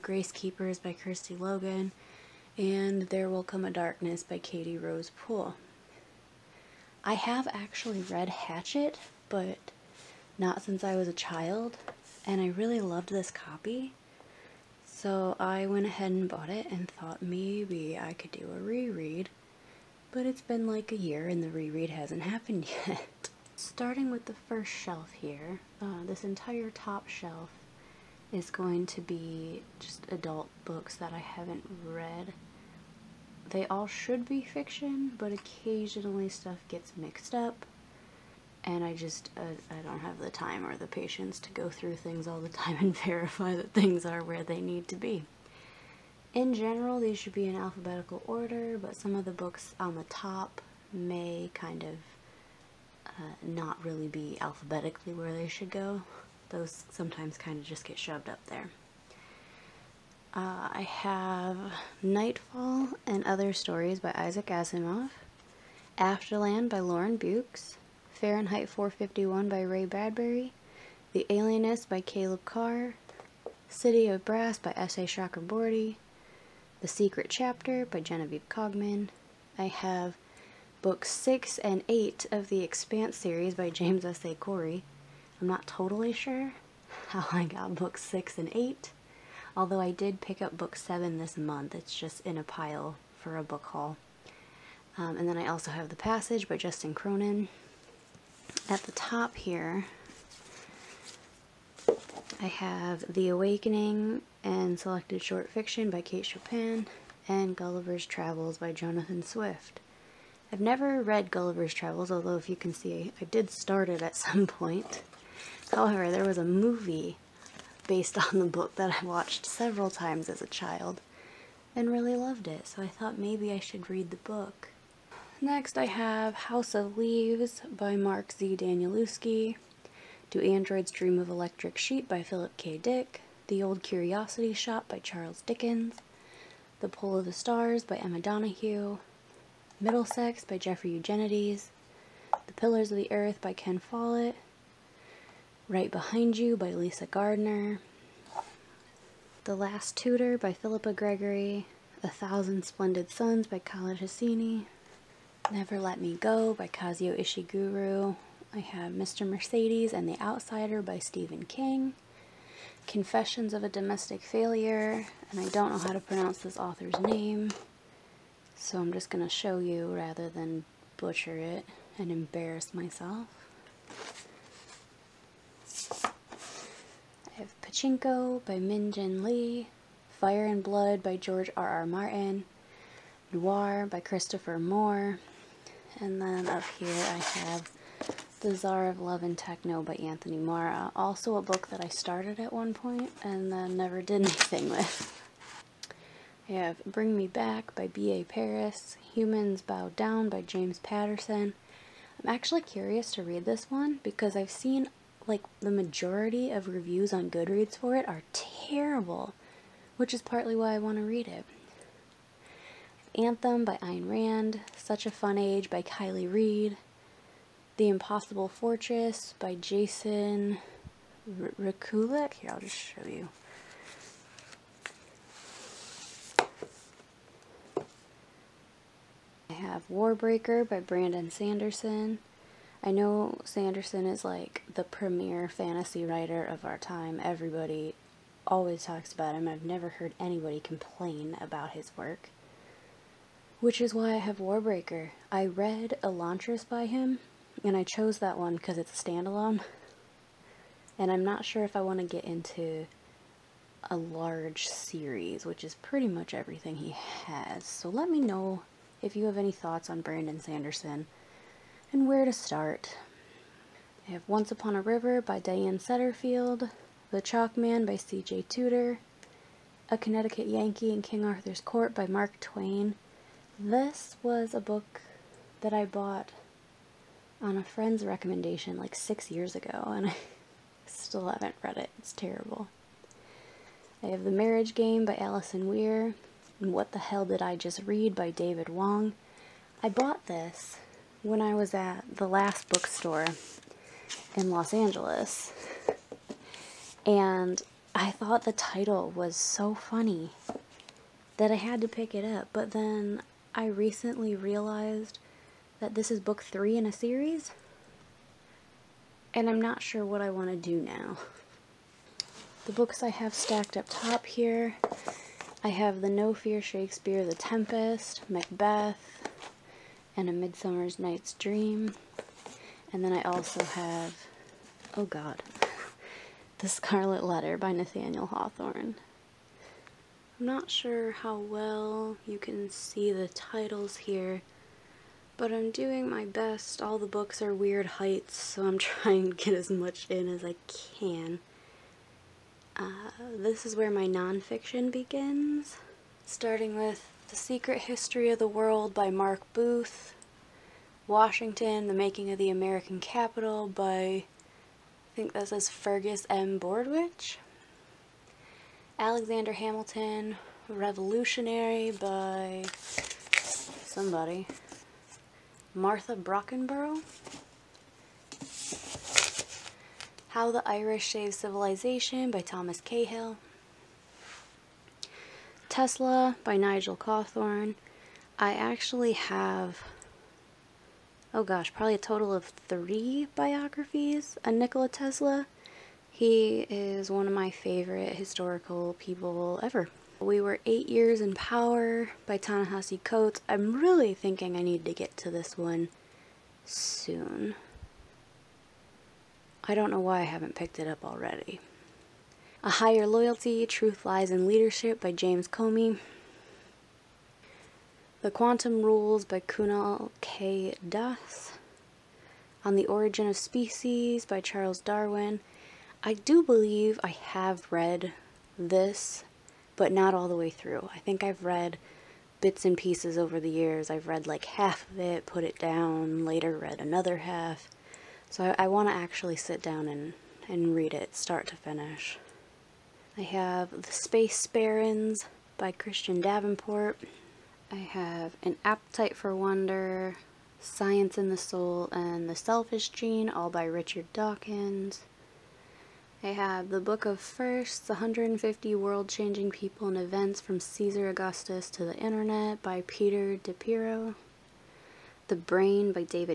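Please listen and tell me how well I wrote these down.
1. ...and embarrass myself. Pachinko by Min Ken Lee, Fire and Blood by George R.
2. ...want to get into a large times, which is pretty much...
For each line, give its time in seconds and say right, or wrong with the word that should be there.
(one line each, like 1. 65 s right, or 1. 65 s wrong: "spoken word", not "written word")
1. 171 s wrong: "Jin", not "Ken"
2. 251 s wrong: "series", not "times".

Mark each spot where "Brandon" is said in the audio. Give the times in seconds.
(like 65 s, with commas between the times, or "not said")
230 s, 260 s.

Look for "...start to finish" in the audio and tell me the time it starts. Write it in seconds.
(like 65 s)
431 s.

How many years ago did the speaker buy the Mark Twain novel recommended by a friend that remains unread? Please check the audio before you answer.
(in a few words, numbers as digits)
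6.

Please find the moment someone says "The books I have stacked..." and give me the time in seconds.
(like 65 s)
312 s.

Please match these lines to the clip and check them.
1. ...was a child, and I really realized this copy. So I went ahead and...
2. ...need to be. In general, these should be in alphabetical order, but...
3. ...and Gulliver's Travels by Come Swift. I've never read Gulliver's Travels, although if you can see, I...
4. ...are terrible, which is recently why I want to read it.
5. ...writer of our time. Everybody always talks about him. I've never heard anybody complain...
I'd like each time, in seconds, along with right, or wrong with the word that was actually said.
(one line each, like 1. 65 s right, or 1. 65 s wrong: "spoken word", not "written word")
1. 10 s wrong: "loved", not "realized"
2. 44 s right
3. 107 s wrong: "Jonathan", not "Come"
4. 208 s wrong: "partly", not "recently"
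5. 236 s right.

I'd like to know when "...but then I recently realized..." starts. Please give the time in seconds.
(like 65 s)
302 s.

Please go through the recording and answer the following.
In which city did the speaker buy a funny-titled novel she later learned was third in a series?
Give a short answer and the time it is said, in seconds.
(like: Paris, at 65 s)
Los Angeles, at 294 s.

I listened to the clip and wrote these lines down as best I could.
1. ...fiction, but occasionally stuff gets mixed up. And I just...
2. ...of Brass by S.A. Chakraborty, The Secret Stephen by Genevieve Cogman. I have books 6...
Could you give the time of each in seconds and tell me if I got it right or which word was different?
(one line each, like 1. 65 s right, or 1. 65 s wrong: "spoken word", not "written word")
1. 34 s right
2. 74 s wrong: "Chapter", not "Stephen".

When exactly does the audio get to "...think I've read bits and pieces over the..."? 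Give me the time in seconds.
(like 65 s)
420 s.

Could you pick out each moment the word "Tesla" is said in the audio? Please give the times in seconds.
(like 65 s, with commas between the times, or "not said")
375 s, 384 s.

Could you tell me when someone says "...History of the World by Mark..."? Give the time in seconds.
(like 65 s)
347 s.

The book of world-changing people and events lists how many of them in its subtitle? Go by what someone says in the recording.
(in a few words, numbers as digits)
150.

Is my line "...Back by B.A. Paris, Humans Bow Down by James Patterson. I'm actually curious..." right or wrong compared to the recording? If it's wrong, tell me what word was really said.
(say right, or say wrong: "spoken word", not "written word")
right.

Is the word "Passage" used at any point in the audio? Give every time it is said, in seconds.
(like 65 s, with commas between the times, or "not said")
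95 s.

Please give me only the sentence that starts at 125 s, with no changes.
Next, I have House of Leaves by Mark Z.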